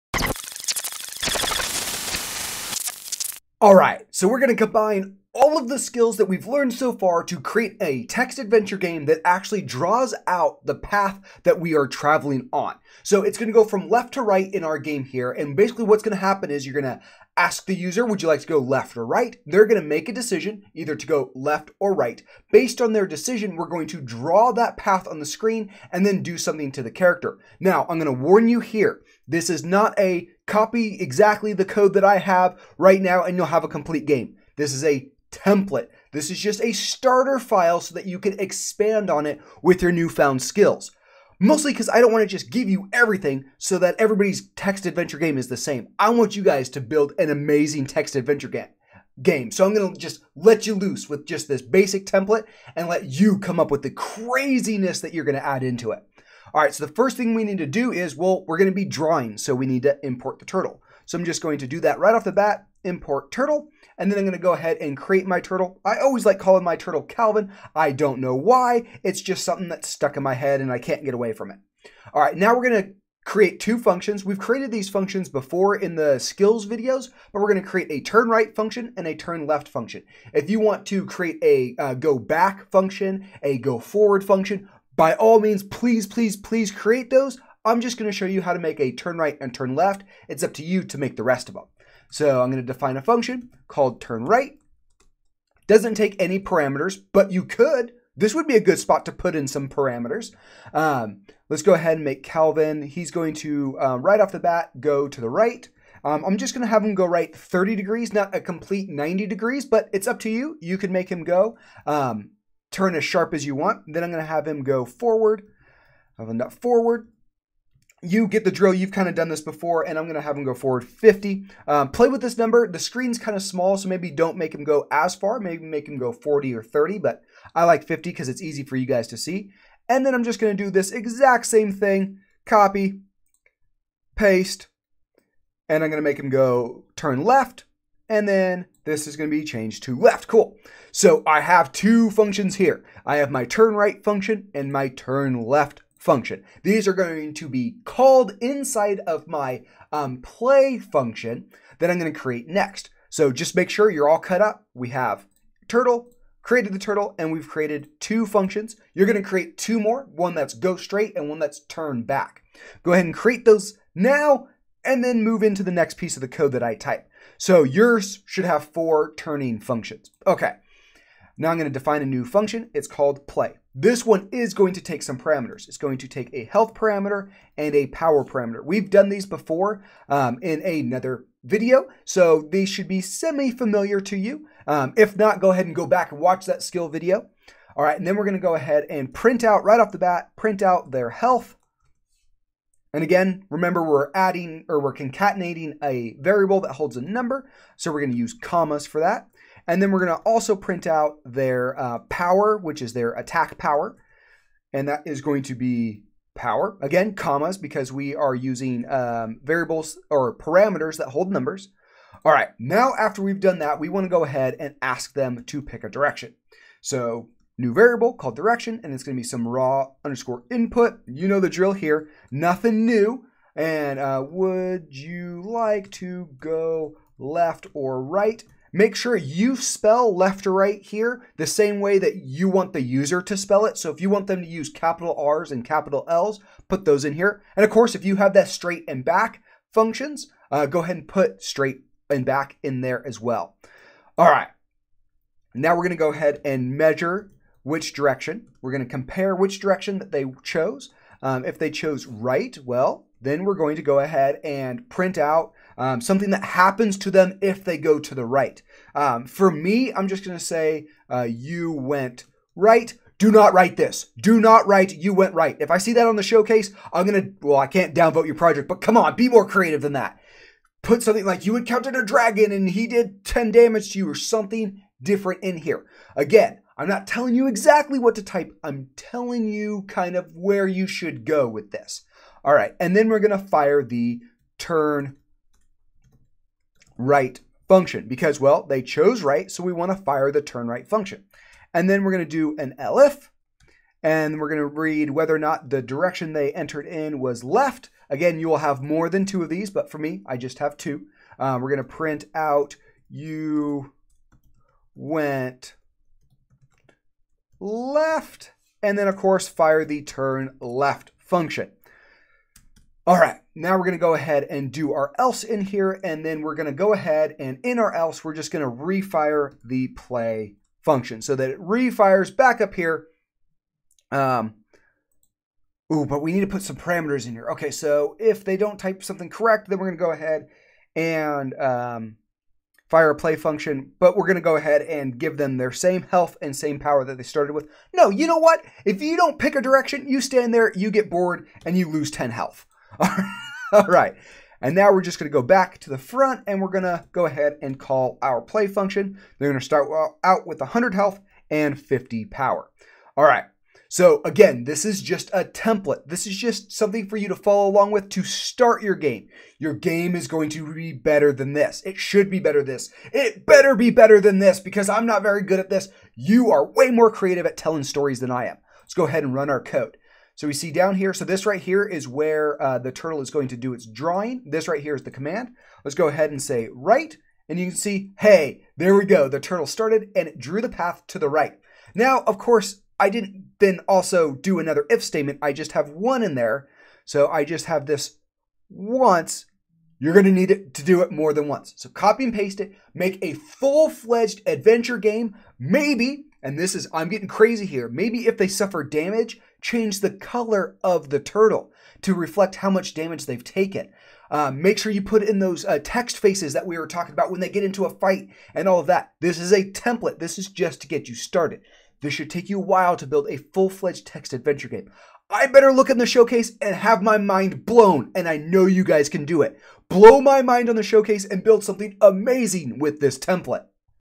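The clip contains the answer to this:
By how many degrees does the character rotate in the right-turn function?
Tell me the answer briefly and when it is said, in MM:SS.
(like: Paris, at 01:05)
30, at 01:47.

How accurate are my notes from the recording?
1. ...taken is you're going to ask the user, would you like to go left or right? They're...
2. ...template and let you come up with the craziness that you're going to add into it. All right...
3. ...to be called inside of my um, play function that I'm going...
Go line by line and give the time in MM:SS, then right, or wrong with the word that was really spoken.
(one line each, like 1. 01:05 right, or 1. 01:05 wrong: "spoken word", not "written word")
1. 00:16 wrong: "happen", not "taken"
2. 00:52 right
3. 02:27 right.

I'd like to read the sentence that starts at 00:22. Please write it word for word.
Based on their decision, we're going to draw that path on the screen and then do something to the character.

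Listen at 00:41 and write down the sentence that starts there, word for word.
Mostly because I don't want to just give you everything so that everybody's text adventure game is the same.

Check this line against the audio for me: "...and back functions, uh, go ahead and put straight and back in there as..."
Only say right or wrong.
right.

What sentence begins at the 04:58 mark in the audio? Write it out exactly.
Again, you will have more than two of these, but for me, I just have two.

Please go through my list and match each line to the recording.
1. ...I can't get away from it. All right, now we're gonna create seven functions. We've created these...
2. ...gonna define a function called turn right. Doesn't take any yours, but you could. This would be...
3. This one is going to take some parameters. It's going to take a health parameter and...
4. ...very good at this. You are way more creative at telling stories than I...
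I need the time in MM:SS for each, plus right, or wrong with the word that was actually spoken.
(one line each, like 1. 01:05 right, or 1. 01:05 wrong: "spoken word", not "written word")
1. 01:10 wrong: "two", not "seven"
2. 01:32 wrong: "parameters", not "yours"
3. 02:53 right
4. 06:05 right.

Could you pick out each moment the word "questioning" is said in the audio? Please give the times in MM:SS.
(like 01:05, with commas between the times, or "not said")
not said.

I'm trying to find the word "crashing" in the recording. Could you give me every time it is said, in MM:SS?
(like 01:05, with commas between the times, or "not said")
not said.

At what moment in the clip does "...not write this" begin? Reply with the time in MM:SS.
04:23.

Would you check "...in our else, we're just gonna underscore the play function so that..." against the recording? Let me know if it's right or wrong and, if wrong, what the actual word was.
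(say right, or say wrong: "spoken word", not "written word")
wrong: "refire", not "underscore".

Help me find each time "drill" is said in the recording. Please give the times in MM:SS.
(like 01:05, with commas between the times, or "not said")
01:58, 03:41.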